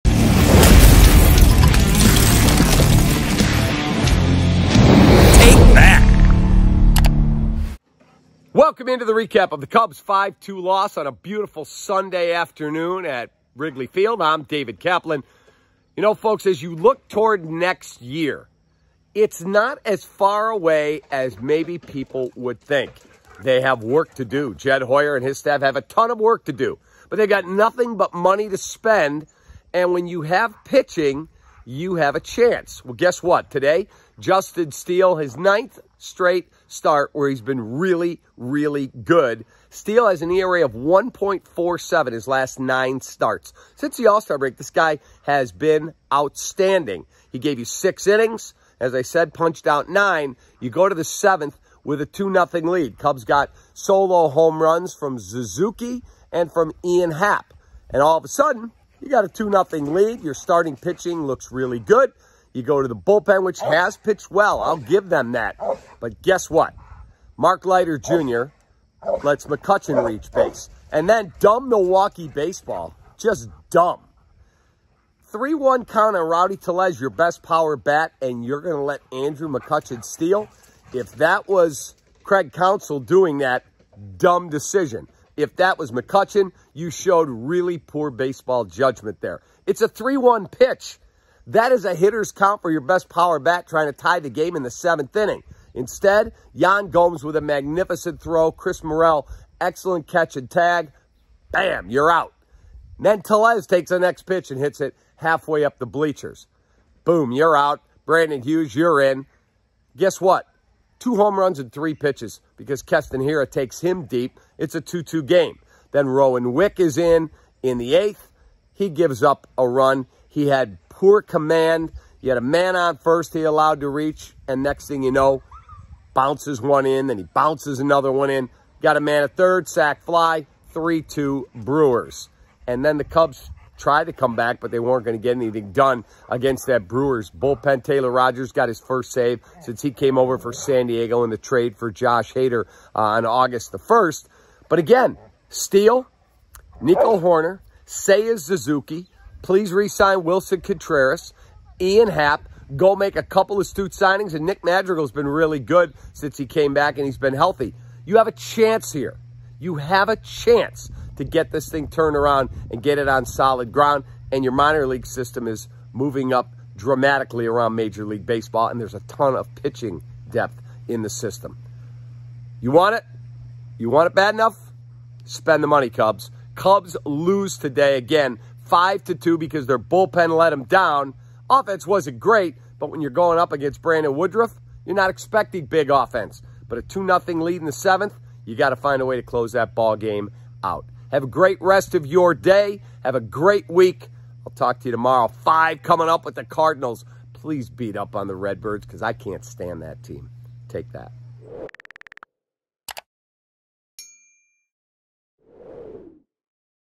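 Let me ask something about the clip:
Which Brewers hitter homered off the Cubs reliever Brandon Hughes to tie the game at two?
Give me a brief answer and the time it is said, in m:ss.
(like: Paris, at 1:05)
Keston Hiura, at 1:52.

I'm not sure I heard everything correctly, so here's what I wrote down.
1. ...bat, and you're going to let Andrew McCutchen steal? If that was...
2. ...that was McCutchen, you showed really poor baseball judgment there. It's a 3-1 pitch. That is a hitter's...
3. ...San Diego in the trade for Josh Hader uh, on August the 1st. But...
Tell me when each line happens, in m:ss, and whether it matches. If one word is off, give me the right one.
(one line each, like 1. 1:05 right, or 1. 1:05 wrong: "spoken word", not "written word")
1. 1:17 right
2. 1:25 right
3. 2:20 right.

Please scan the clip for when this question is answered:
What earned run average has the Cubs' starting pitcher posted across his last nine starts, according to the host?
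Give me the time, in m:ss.
0:40.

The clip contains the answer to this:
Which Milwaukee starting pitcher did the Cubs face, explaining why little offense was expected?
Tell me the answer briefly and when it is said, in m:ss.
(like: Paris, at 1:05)
Brandon Woodruff, at 3:03.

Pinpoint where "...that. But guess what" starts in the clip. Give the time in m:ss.
1:05.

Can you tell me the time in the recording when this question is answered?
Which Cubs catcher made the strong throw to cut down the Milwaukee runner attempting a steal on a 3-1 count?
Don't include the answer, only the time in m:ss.
1:36.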